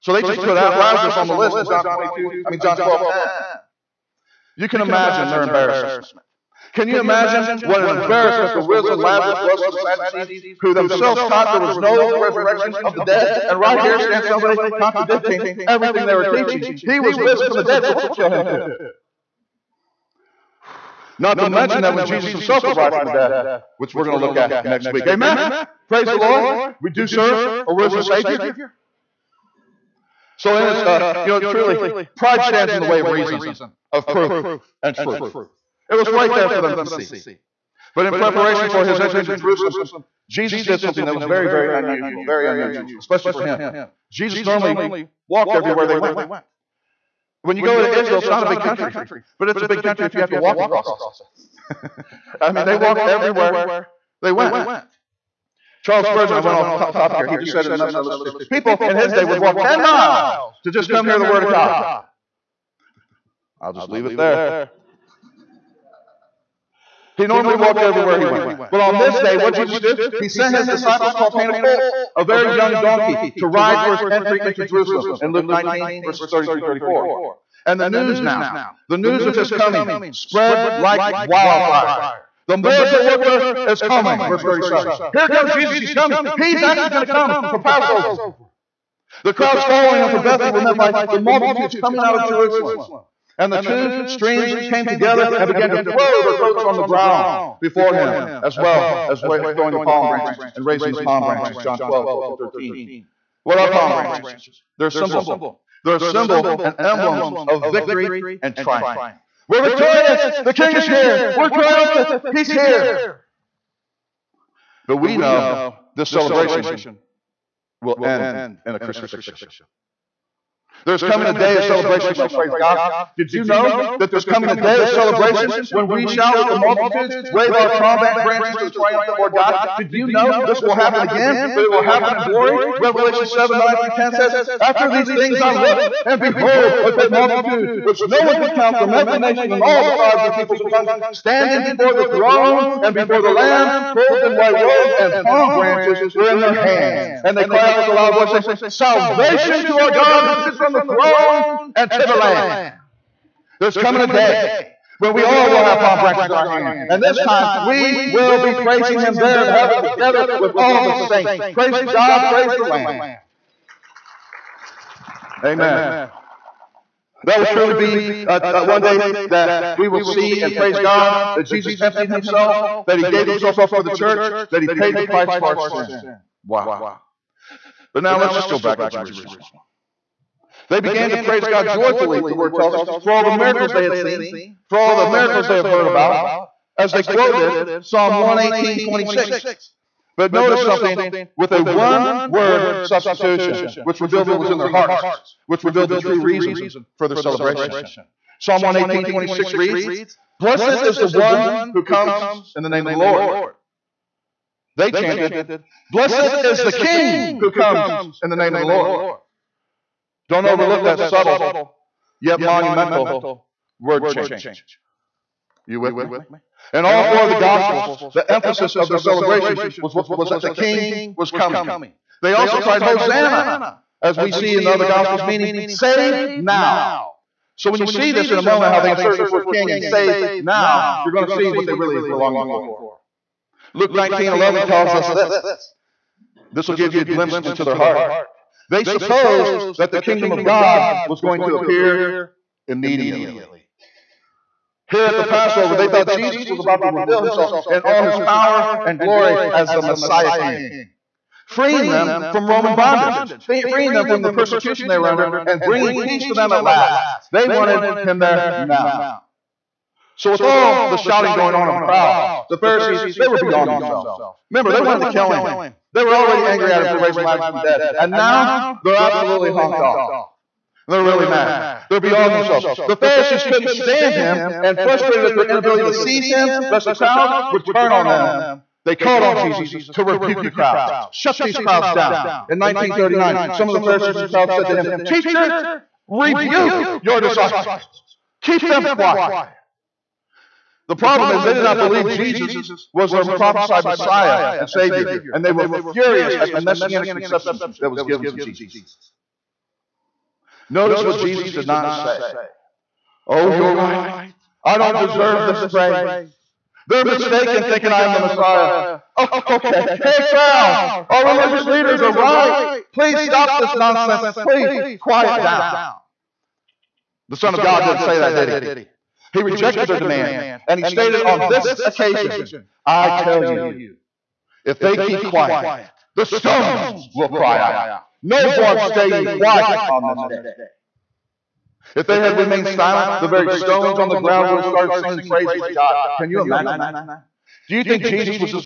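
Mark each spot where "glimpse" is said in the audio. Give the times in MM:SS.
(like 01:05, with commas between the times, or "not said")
03:57.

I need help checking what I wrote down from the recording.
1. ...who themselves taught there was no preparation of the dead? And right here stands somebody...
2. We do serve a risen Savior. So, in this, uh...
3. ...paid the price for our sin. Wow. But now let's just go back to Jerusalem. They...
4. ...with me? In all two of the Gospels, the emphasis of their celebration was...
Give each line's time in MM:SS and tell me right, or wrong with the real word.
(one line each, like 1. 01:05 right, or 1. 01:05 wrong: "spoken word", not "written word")
1. 00:10 wrong: "resurrection", not "preparation"
2. 00:26 right
3. 02:54 right
4. 03:35 wrong: "four", not "two".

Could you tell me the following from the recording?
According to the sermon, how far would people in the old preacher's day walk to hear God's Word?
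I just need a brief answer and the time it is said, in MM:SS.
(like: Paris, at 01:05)
10, at 00:59.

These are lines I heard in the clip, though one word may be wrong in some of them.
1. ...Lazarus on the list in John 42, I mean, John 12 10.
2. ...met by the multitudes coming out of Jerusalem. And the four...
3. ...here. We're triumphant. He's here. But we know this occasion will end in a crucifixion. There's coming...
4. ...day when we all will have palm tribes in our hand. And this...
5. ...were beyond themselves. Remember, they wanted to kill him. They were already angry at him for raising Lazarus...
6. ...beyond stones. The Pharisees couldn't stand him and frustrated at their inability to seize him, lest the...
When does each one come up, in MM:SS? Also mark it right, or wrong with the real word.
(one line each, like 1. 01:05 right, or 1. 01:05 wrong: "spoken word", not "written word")
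1. 00:00 wrong: "22", not "42"
2. 01:30 wrong: "two", not "four"
3. 01:50 wrong: "celebration", not "occasion"
4. 02:34 wrong: "branches", not "tribes"
5. 04:23 right
6. 04:31 wrong: "themselves", not "stones".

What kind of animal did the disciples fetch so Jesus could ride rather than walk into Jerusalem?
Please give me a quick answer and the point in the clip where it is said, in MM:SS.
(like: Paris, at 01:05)
A colt, at 01:11.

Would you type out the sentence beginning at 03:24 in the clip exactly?
They chanted, Blessed is the King who comes in the name of the Lord.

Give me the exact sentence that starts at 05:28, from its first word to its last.
No one staying quiet on this day.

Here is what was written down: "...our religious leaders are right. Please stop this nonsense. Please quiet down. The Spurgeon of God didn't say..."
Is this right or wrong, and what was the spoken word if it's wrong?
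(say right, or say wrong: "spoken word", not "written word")
wrong: "Son", not "Spurgeon".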